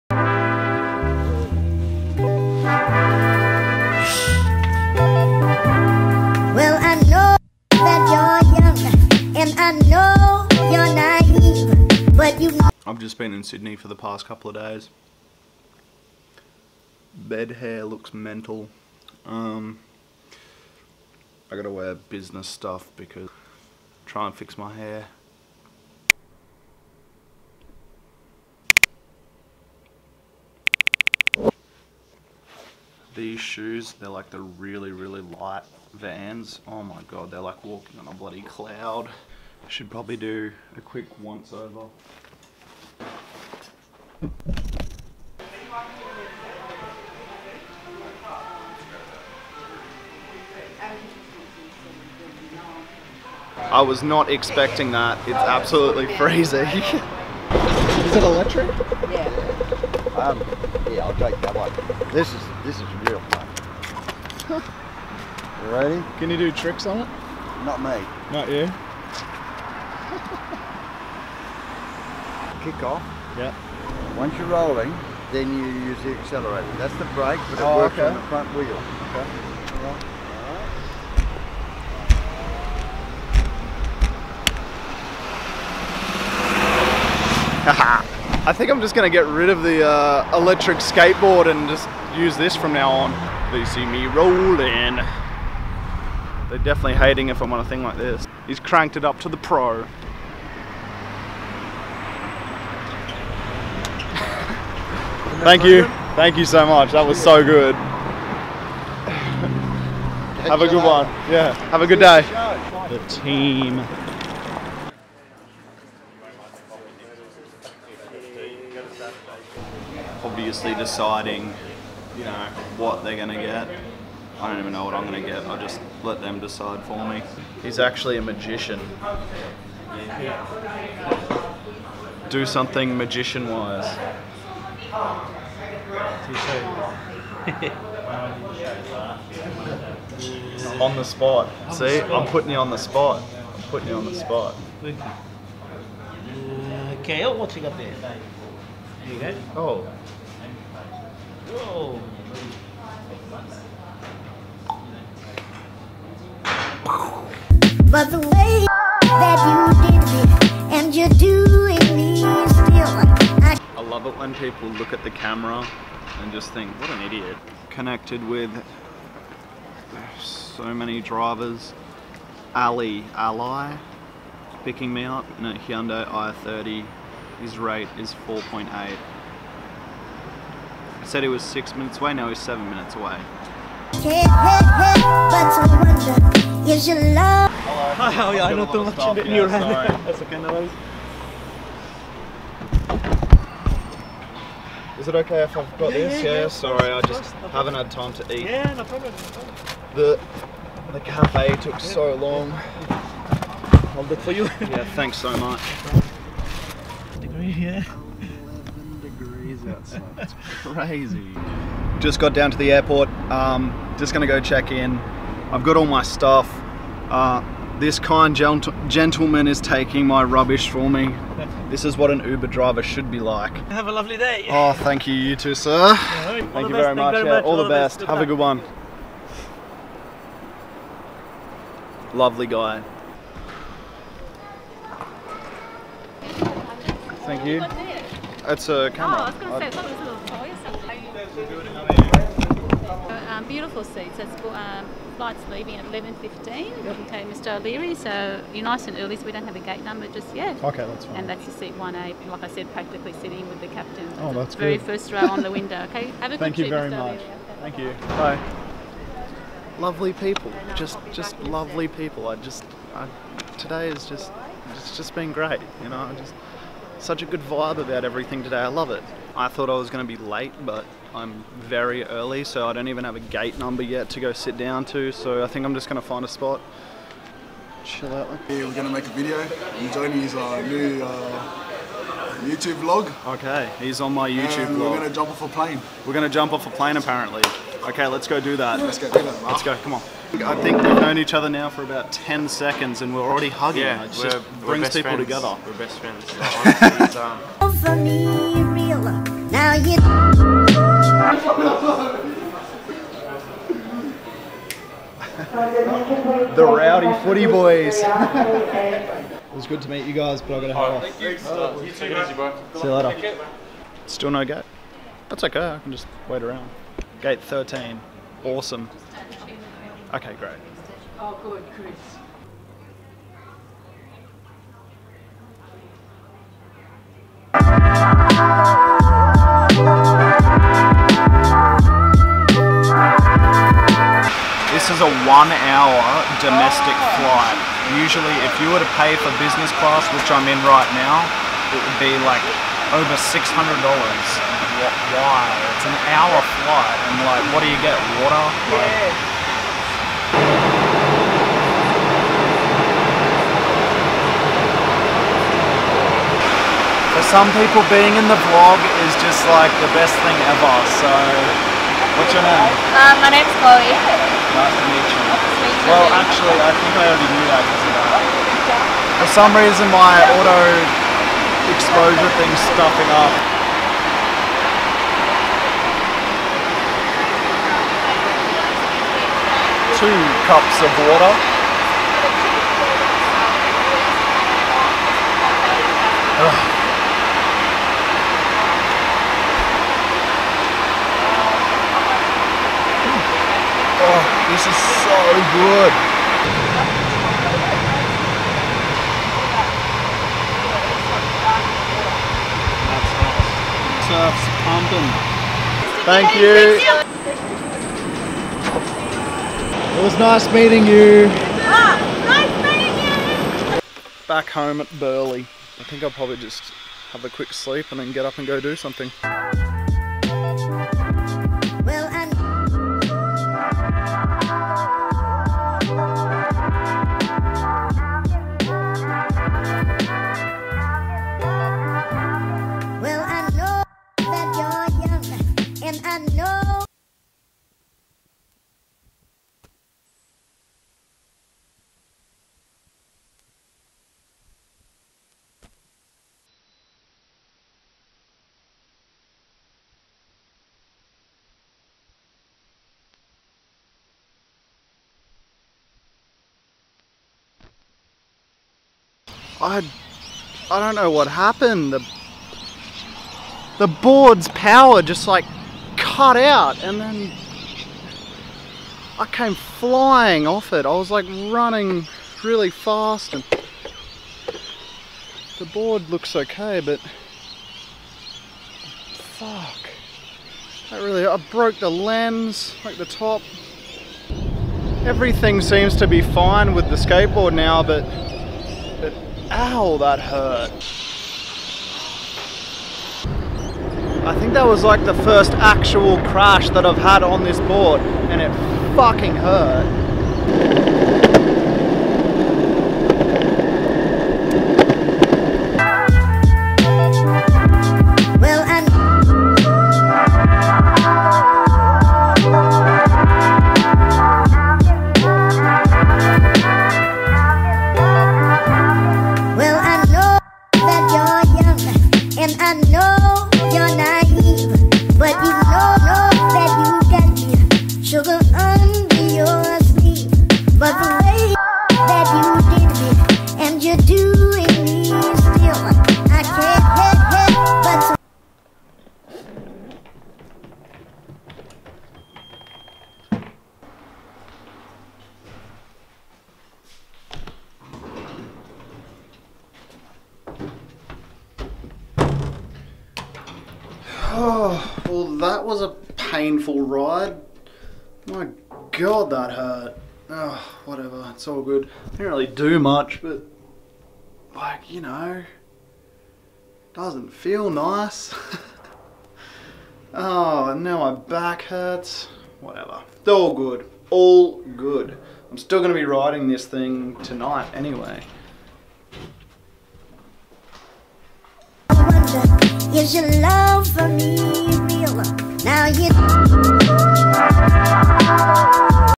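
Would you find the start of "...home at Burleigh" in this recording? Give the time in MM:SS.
06:54.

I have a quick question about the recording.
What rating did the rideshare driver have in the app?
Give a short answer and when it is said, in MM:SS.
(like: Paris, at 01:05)
4.8, at 02:58.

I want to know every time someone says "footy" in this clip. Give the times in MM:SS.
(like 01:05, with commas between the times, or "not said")
05:07.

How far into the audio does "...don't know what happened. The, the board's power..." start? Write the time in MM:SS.
07:40.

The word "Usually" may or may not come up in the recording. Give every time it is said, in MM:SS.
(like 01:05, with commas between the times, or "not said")
05:37.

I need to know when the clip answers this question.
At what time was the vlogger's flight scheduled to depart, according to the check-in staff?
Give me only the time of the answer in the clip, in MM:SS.
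04:05.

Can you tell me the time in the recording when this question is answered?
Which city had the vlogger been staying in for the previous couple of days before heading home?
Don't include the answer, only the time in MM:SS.
00:13.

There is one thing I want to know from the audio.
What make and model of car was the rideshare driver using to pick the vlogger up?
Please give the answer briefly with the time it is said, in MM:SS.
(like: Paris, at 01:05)
Hyundai i30, at 02:55.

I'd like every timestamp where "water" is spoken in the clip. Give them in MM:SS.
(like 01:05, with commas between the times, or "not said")
05:48, 06:20.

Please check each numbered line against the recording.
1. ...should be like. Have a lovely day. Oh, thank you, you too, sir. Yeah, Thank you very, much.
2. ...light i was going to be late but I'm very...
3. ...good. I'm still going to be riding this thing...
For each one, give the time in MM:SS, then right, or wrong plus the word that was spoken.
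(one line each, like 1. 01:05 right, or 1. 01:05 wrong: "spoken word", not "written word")
1. 03:42 right
2. 04:29 wrong: "thought", not "light"
3. 09:34 right.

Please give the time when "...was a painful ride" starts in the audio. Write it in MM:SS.
09:15.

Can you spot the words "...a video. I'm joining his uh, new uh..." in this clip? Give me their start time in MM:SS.
04:39.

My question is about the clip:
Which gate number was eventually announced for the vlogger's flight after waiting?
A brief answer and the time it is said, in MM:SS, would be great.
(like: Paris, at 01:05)
Gate 13, at 05:17.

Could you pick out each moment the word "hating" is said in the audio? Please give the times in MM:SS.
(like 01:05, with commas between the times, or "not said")
01:36.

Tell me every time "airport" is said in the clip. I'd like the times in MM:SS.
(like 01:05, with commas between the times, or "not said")
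03:32.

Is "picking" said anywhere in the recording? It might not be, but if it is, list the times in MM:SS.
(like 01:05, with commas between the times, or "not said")
02:54.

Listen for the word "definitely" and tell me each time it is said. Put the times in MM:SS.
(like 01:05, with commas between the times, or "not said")
01:36.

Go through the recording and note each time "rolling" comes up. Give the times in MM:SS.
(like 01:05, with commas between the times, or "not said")
01:14, 01:34.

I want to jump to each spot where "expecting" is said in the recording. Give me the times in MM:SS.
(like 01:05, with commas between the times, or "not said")
00:54.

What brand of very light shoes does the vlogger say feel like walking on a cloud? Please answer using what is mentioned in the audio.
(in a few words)
Vans.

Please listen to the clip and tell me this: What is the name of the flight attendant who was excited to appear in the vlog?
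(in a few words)
Chloe.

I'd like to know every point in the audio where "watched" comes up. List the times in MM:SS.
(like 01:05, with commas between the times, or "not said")
not said.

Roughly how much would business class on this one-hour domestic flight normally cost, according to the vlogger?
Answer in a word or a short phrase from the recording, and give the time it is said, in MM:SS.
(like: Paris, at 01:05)
Over $600, at 05:42.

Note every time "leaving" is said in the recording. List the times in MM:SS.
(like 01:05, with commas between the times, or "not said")
04:05.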